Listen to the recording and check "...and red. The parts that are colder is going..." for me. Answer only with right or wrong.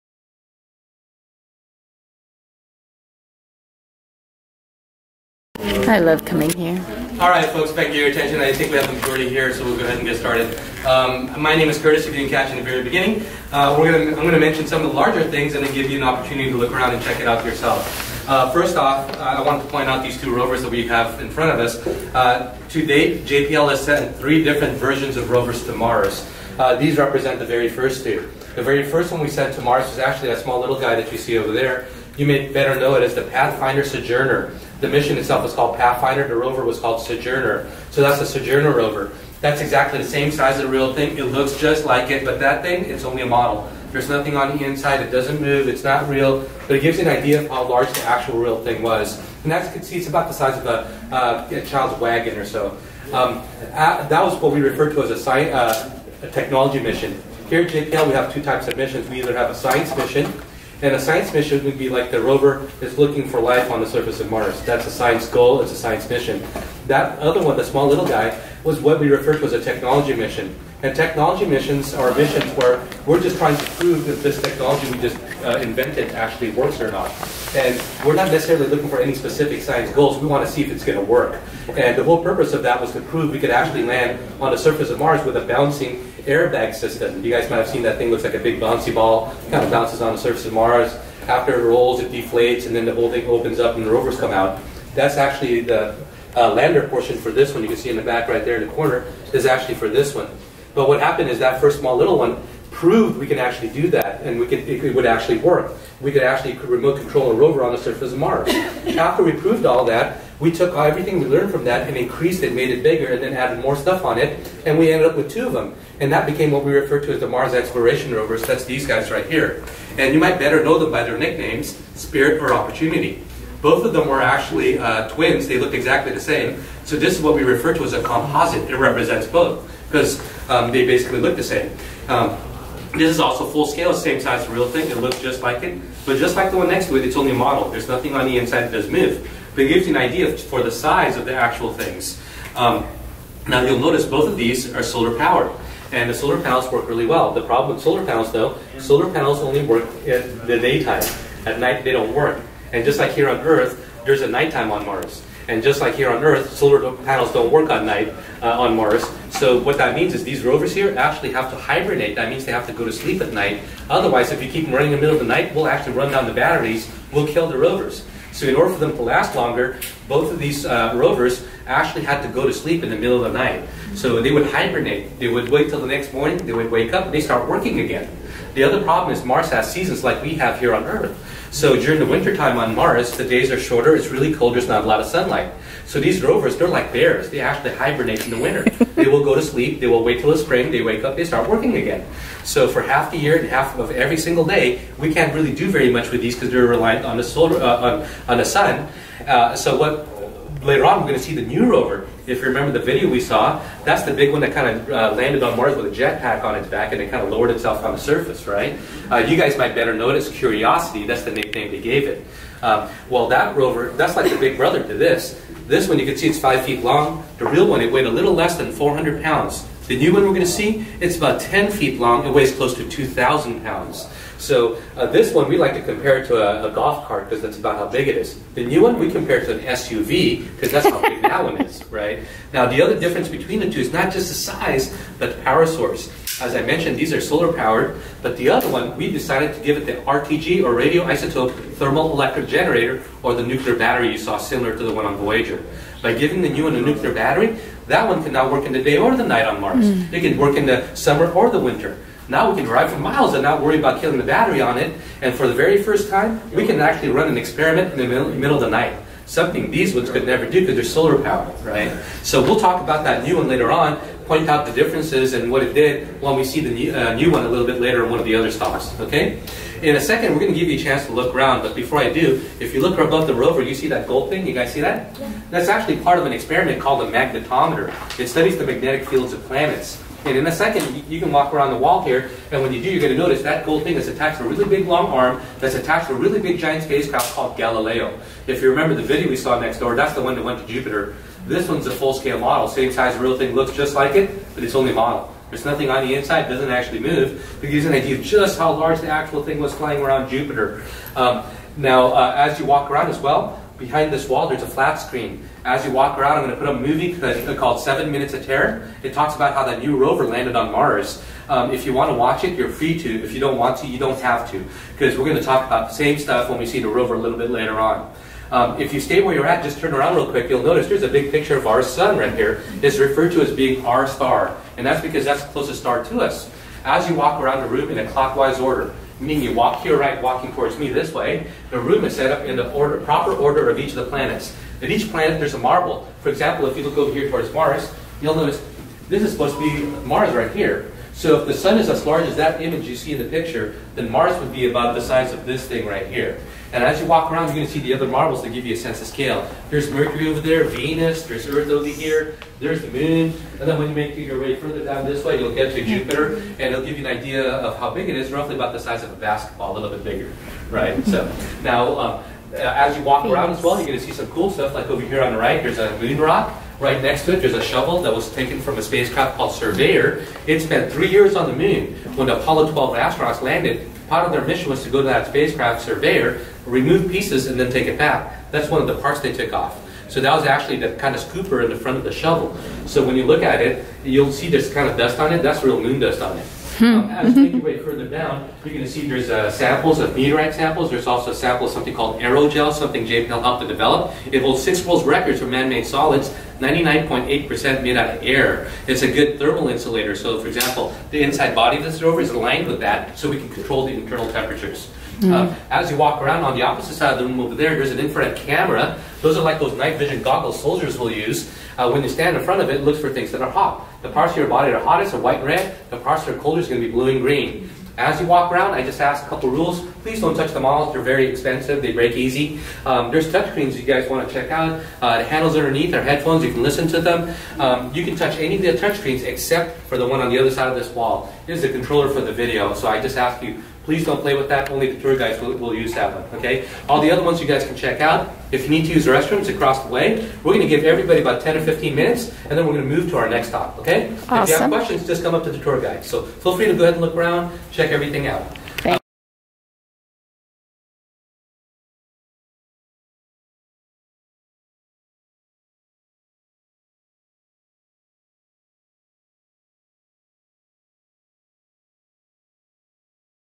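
right.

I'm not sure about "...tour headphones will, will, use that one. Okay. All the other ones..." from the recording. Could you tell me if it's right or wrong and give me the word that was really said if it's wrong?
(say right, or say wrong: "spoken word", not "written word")
wrong: "guides", not "headphones".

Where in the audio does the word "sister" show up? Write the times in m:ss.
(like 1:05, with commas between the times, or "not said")
not said.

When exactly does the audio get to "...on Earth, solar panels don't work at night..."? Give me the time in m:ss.
2:36.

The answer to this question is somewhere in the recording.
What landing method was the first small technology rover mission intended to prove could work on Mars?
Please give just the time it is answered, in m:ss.
1:25.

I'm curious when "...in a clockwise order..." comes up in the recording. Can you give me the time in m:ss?
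5:27.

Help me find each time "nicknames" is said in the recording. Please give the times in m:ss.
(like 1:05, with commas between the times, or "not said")
2:01, 3:31.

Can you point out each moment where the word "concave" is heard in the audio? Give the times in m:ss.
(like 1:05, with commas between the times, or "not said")
not said.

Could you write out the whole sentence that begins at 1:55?
And that became what we refer to as the Mars Exploration Rovers.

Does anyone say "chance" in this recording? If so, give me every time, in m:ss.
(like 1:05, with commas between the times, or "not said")
4:30.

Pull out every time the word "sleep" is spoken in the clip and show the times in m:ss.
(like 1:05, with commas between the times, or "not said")
2:42, 2:52, 3:09.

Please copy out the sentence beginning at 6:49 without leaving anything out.
Those are like those night vision goggles soldiers will use.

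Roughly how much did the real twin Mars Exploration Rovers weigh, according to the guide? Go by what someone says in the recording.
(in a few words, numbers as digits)
less than 400 pounds.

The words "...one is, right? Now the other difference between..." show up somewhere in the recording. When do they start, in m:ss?
3:51.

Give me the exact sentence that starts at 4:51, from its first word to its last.
This one's a full-scale model, same size real thing, looks just like it, but it's only model.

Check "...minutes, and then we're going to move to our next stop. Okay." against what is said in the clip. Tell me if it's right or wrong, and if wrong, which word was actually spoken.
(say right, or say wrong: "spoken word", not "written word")
right.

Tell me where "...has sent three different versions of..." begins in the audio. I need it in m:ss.
0:23.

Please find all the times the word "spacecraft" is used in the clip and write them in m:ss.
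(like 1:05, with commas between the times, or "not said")
4:46, 6:08, 6:15.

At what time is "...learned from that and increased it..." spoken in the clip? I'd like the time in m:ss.
1:51.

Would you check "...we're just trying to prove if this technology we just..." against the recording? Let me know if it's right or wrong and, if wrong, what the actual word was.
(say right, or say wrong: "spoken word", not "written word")
right.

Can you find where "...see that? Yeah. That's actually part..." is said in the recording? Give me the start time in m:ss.
4:34.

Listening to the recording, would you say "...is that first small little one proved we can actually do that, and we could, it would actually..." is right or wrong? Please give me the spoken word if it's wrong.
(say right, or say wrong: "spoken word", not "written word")
right.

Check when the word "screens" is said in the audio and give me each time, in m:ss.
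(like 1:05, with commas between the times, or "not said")
5:04, 7:03, 7:08.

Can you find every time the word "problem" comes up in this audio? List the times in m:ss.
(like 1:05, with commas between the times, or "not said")
2:27, 2:58.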